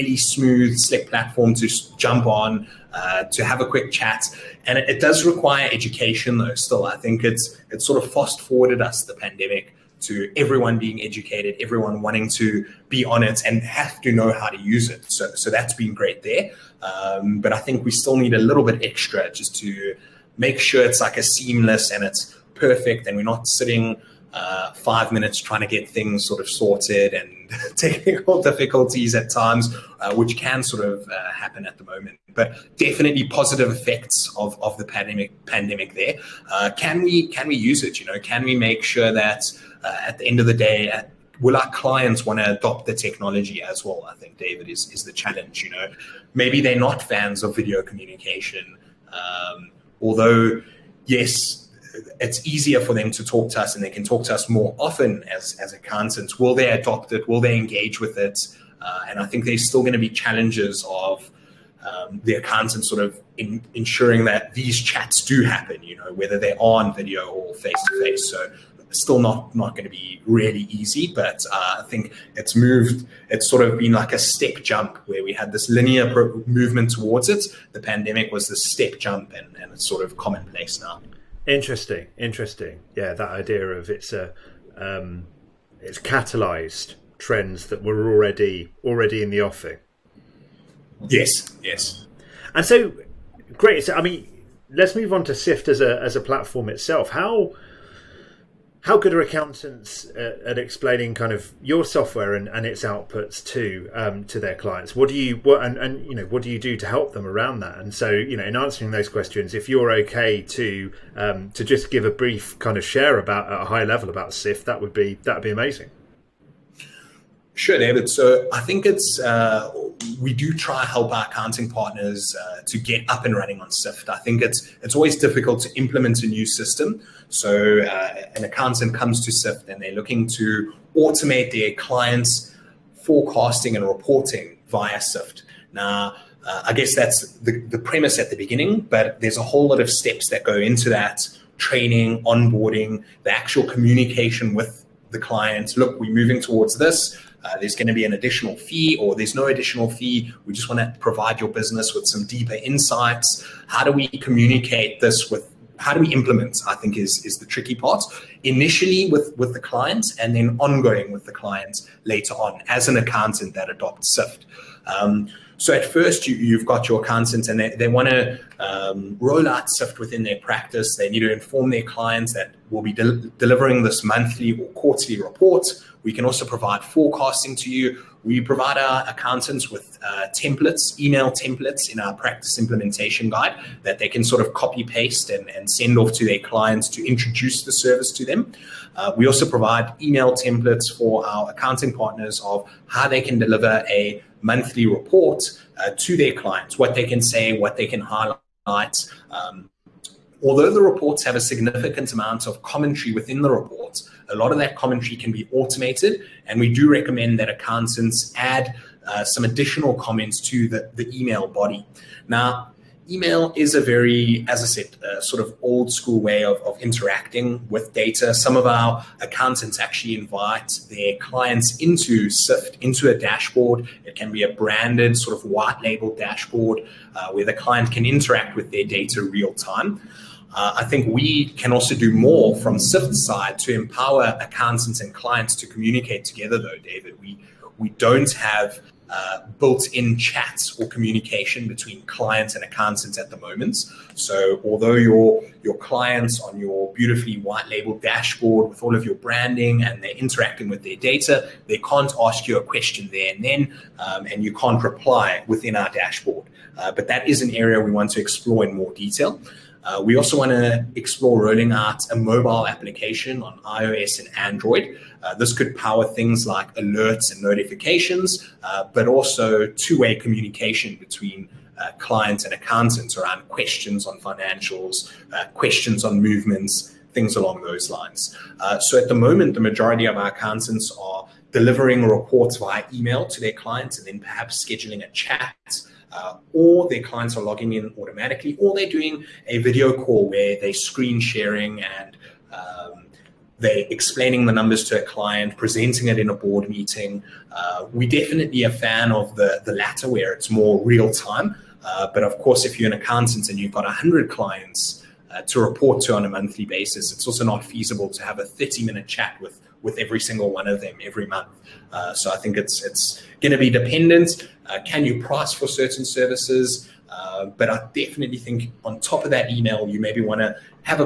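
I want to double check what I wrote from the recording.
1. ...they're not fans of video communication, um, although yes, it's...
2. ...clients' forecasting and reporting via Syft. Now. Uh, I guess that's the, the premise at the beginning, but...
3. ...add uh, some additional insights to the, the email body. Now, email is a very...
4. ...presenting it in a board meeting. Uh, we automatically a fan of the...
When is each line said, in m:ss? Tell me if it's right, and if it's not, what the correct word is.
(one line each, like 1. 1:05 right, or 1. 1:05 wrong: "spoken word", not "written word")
1. 0:46 right
2. 2:11 right
3. 3:28 wrong: "comments", not "insights"
4. 4:55 wrong: "definitely", not "automatically".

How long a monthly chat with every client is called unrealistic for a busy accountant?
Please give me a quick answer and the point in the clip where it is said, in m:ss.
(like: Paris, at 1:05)
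30 minutes, at 5:08.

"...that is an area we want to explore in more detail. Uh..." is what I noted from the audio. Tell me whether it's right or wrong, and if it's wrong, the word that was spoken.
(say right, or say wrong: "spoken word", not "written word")
right.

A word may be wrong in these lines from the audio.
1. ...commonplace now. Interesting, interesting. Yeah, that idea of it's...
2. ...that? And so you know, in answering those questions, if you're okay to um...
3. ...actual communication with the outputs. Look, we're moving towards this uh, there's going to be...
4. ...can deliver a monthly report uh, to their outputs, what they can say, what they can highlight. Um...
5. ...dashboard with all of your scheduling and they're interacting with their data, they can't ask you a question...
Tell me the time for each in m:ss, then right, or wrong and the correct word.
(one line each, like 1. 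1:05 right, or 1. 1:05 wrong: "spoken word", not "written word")
1. 1:20 right
2. 1:47 right
3. 2:23 wrong: "clients", not "outputs"
4. 3:13 wrong: "clients", not "outputs"
5. 4:08 wrong: "branding", not "scheduling".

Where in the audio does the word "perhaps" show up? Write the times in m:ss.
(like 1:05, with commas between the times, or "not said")
4:44.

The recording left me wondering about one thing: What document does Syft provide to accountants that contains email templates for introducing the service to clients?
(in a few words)
practice implementation guide.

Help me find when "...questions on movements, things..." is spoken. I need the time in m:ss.
4:35.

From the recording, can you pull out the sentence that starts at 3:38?
Some of our accountants actually invite their clients into Syft, into a dashboard.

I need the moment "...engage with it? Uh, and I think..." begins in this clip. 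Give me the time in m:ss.
0:57.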